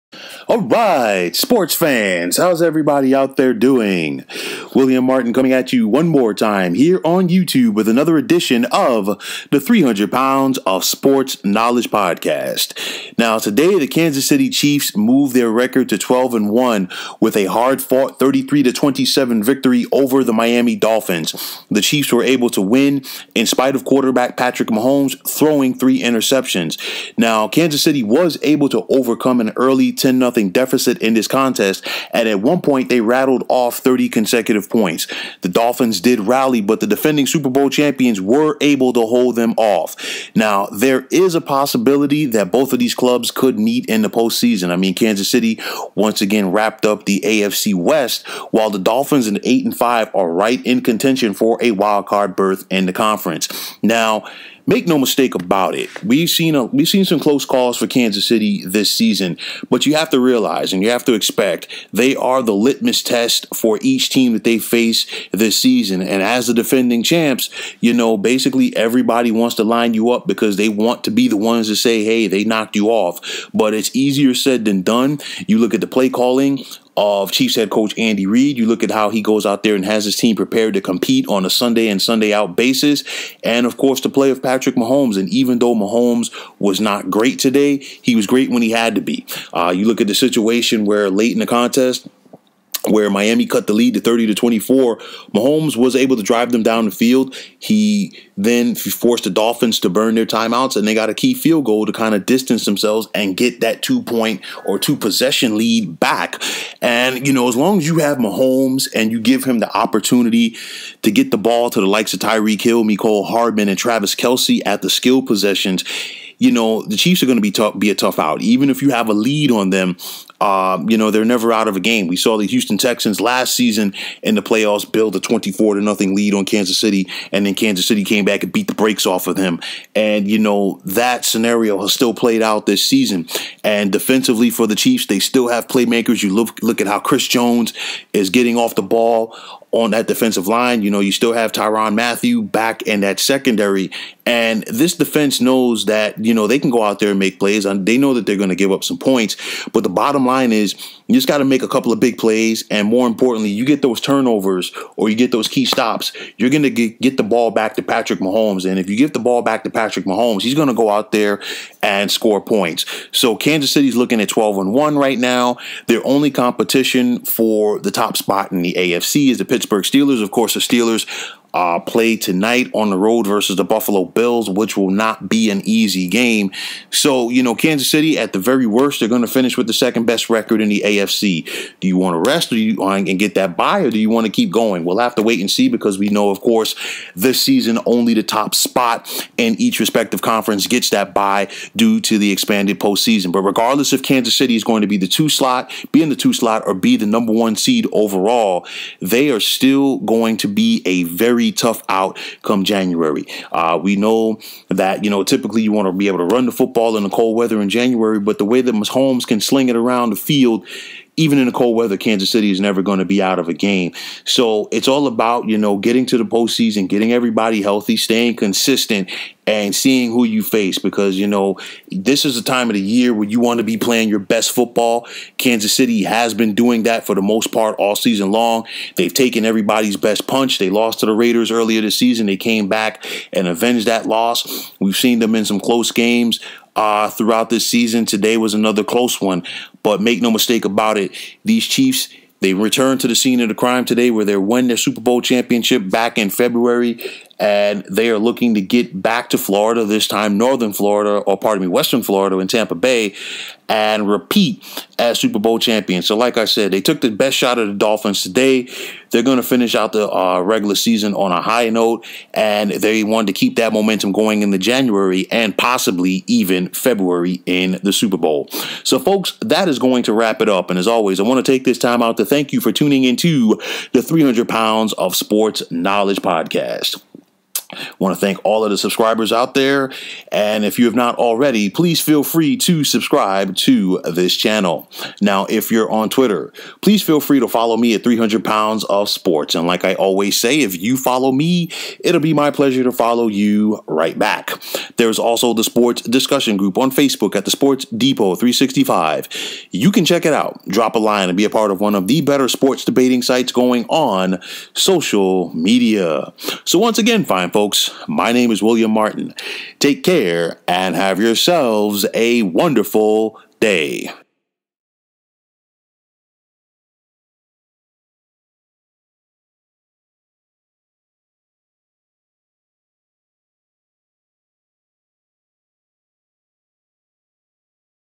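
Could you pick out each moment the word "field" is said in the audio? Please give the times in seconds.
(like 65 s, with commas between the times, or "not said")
96 s, 101 s, 210 s.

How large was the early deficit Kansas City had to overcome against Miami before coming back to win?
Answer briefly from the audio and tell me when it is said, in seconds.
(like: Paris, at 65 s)
10-0, at 29 s.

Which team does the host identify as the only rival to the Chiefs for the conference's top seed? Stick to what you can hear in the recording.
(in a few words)
Pittsburgh Steelers.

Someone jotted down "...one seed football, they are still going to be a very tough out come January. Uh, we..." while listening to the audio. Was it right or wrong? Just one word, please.
wrong.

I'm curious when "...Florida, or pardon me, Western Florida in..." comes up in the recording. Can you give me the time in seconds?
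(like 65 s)
250 s.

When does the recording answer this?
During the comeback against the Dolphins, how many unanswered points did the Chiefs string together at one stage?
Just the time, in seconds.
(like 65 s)
33 s.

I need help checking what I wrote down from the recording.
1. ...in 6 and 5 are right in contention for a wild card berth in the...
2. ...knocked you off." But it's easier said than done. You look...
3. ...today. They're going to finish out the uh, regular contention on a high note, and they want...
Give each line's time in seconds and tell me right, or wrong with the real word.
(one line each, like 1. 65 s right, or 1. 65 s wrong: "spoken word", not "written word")
1. 49 s wrong: "8", not "6"
2. 72 s right
3. 258 s wrong: "season", not "contention".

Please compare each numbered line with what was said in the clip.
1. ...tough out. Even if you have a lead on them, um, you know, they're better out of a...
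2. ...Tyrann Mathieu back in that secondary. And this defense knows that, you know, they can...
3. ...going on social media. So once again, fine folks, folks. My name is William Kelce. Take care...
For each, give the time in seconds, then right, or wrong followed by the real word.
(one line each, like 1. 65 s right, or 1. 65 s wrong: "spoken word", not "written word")
1. 117 s wrong: "never", not "better"
2. 141 s right
3. 303 s wrong: "Martin", not "Kelce".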